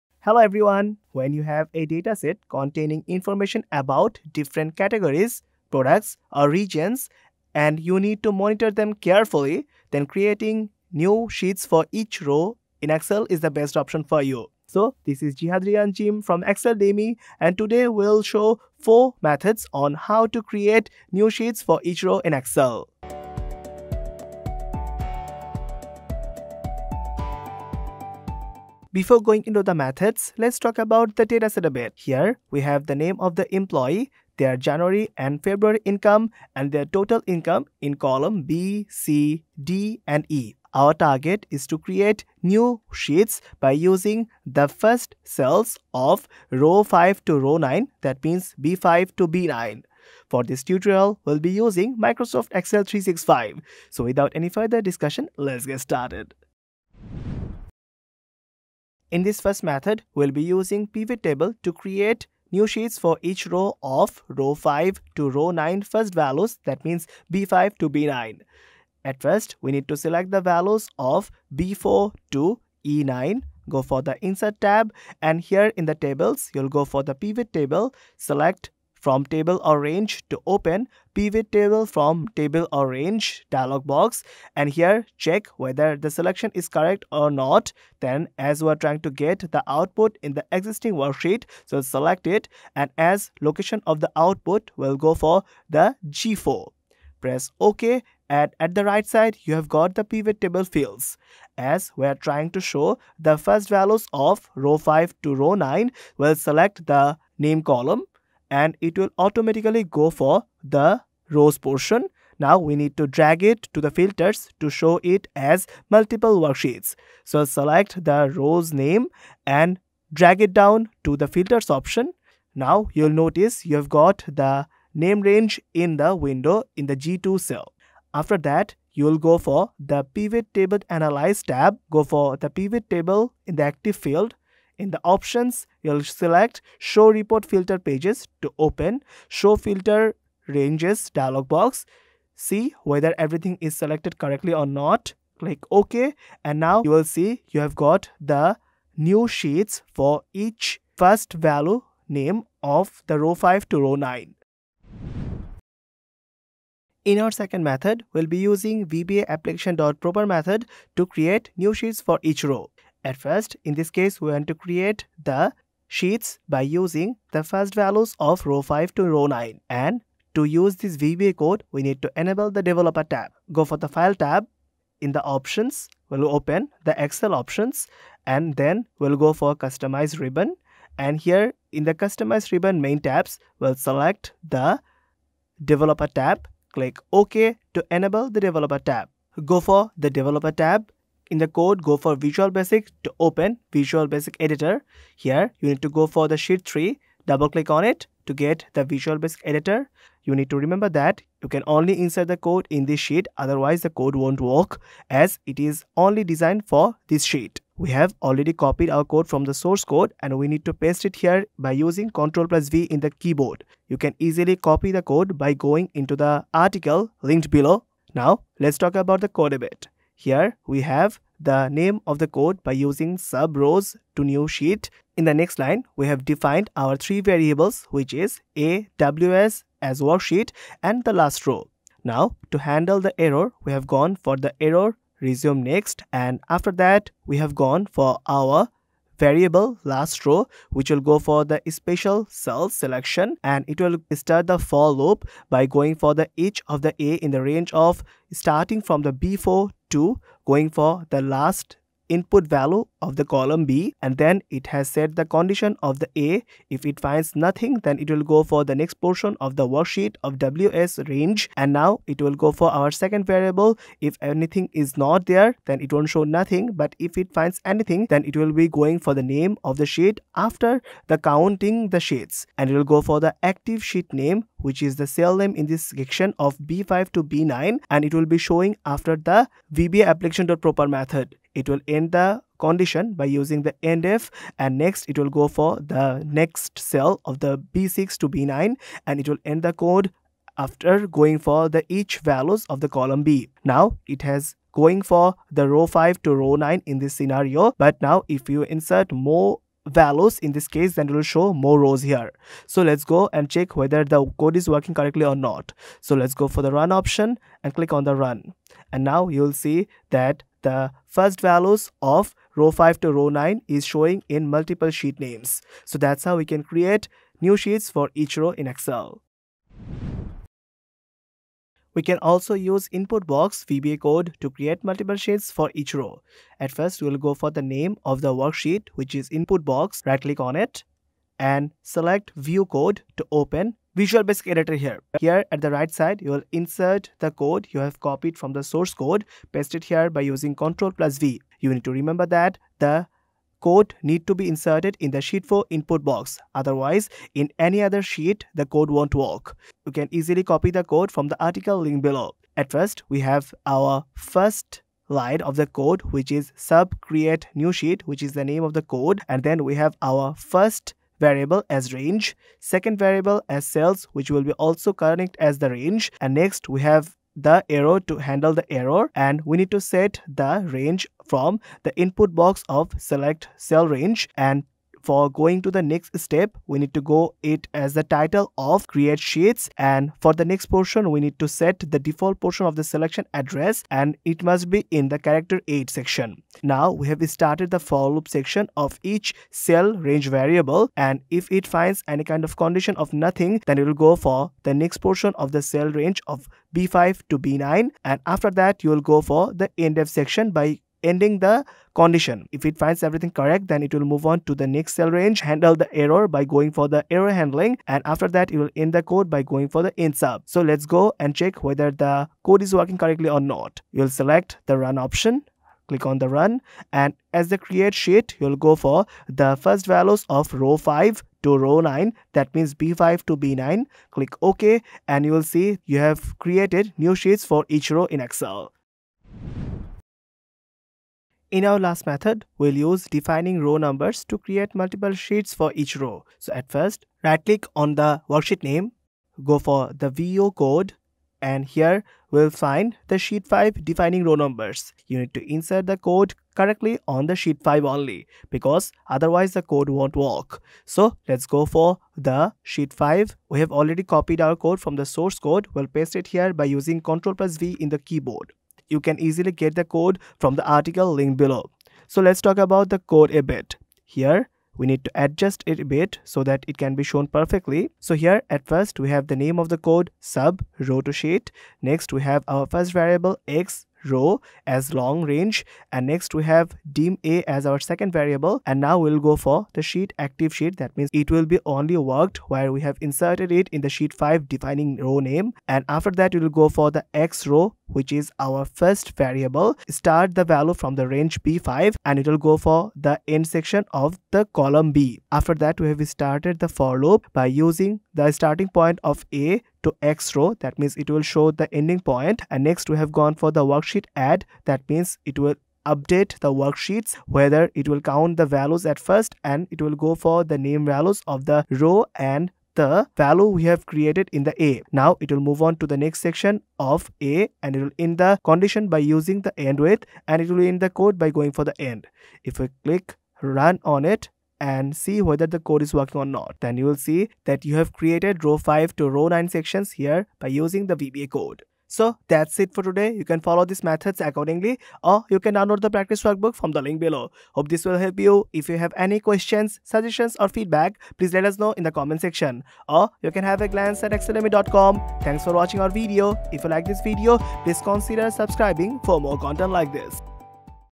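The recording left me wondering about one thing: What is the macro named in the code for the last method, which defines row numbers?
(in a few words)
row to sheet.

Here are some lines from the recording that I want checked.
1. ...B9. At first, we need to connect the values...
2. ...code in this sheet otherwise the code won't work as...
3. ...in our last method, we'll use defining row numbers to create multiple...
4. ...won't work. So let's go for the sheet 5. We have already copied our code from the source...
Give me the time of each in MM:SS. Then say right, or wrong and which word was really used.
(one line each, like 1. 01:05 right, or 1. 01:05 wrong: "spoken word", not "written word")
1. 01:07 wrong: "select", not "connect"
2. 03:22 right
3. 07:11 right
4. 07:29 right.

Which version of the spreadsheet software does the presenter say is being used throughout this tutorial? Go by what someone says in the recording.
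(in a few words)
Microsoft Excel 365.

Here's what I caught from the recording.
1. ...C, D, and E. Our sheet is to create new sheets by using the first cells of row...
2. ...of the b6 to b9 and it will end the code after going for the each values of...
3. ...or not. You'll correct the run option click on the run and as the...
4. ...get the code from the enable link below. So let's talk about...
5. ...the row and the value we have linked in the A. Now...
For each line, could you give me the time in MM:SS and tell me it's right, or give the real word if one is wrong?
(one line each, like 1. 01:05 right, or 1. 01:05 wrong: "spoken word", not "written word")
1. 00:38 wrong: "target", not "sheet"
2. 04:47 right
3. 06:53 wrong: "select", not "correct"
4. 07:39 wrong: "article", not "enable"
5. 08:31 wrong: "created", not "linked".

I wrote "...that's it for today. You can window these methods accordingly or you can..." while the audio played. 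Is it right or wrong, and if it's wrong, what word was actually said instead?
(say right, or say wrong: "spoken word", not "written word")
wrong: "follow", not "window".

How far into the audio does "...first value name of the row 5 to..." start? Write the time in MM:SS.
02:30.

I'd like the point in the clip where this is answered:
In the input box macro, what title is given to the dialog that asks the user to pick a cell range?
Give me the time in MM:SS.
06:18.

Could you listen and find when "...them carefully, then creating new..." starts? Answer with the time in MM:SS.
00:08.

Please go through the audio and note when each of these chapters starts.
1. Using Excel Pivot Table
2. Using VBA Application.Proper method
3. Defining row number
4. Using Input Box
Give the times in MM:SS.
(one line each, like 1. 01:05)
1. 00:58
2. 02:36
3. 07:11
4. 05:21.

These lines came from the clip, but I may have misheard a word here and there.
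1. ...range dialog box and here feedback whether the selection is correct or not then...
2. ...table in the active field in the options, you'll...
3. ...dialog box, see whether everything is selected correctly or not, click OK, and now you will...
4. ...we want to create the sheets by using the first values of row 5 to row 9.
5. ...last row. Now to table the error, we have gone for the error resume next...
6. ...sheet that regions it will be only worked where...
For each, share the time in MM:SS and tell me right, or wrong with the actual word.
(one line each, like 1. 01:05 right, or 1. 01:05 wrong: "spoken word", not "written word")
1. 01:22 wrong: "check", not "feedback"
2. 02:12 right
3. 02:21 right
4. 02:44 right
5. 03:51 wrong: "handle", not "table"
6. 08:00 wrong: "means", not "regions".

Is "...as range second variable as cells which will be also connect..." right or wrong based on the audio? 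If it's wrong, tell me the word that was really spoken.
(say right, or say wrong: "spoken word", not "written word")
right.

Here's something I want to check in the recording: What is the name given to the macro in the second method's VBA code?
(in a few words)
rows to new sheet.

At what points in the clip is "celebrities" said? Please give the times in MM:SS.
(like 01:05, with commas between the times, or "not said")
not said.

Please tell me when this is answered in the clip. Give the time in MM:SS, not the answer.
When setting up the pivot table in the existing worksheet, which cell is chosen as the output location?
01:36.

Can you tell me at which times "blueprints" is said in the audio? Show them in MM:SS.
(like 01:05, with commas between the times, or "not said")
not said.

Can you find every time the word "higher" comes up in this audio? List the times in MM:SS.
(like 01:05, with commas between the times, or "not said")
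not said.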